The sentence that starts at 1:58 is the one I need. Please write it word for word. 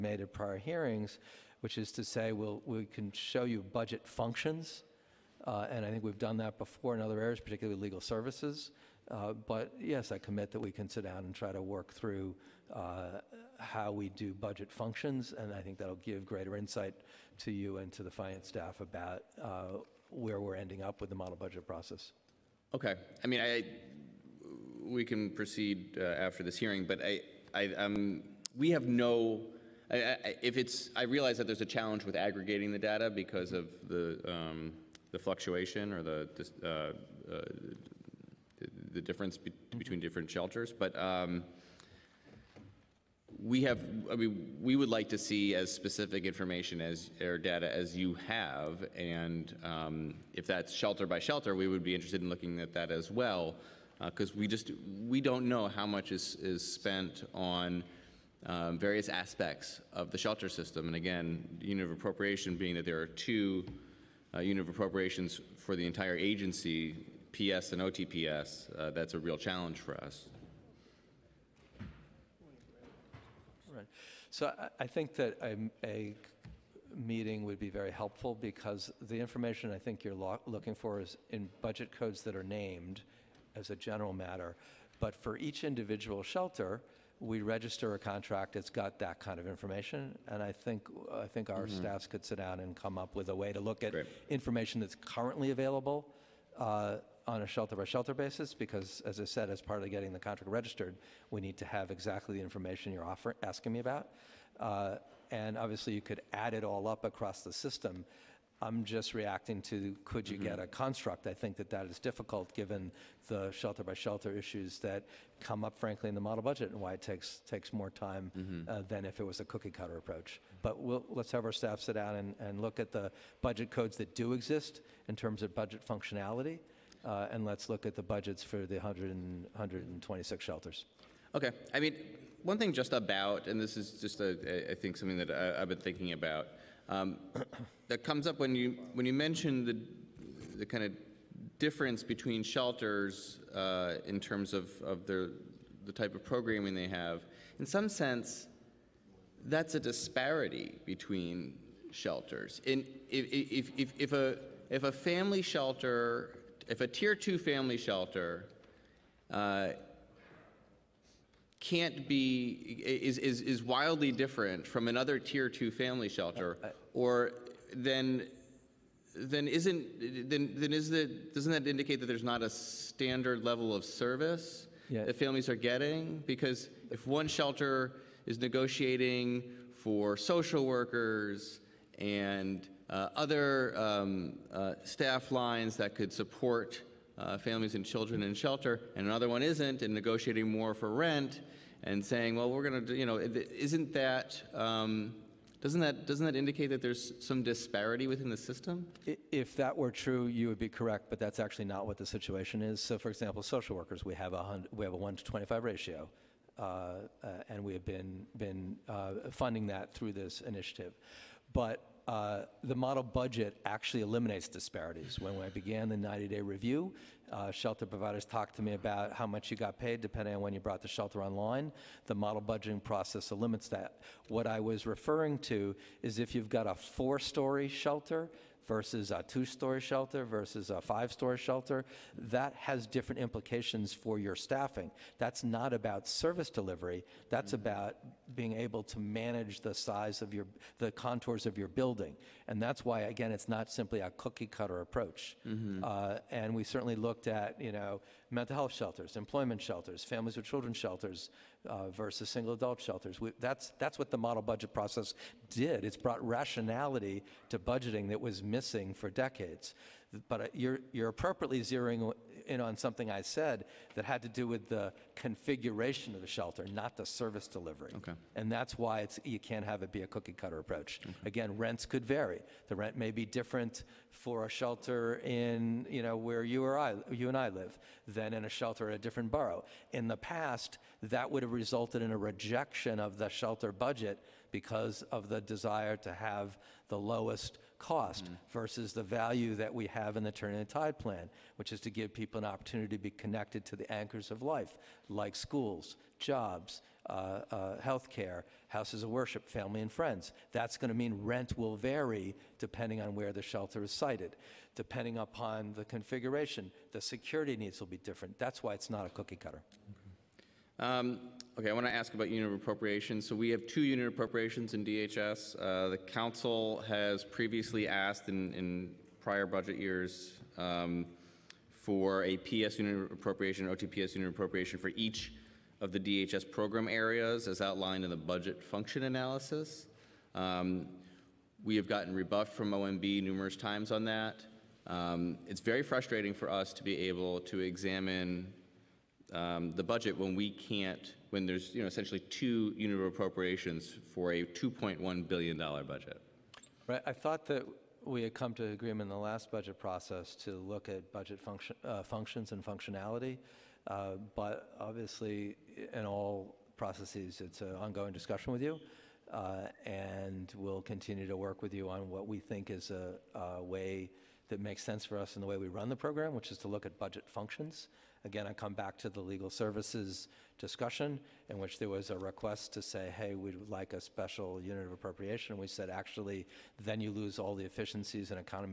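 uh, than if it was a cookie cutter approach.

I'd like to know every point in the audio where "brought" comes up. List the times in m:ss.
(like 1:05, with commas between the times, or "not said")
3:40, 4:15.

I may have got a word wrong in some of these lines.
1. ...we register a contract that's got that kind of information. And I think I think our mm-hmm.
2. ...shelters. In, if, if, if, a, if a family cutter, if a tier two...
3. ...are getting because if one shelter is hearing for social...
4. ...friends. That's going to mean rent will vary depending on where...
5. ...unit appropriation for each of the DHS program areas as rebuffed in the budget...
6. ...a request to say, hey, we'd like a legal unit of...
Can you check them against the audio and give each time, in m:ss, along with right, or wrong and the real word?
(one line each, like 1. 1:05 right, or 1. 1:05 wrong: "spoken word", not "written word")
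1. 1:27 right
2. 2:31 wrong: "shelter", not "cutter"
3. 2:55 wrong: "negotiating", not "hearing"
4. 4:59 right
5. 5:24 wrong: "outlined", not "rebuffed"
6. 6:12 wrong: "special", not "legal".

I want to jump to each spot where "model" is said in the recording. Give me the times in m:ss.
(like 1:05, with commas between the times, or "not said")
0:21, 1:56, 3:32, 3:42, 4:14.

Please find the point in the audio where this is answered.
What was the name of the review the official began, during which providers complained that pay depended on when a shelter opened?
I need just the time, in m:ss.
3:35.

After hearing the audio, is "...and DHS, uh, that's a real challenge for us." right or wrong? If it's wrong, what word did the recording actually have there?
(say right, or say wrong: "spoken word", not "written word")
wrong: "OTPS", not "DHS".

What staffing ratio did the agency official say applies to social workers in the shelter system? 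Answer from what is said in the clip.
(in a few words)
1 to 25.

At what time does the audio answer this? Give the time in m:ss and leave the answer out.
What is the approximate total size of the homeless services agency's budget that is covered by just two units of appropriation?
5:44.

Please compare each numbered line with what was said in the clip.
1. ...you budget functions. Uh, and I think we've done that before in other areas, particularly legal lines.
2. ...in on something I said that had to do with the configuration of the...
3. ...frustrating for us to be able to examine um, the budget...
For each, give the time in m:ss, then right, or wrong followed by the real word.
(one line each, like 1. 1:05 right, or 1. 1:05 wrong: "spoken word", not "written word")
1. 0:03 wrong: "services", not "lines"
2. 4:22 right
3. 5:35 right.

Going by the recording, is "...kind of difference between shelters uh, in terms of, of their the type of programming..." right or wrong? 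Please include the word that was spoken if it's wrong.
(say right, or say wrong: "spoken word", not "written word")
right.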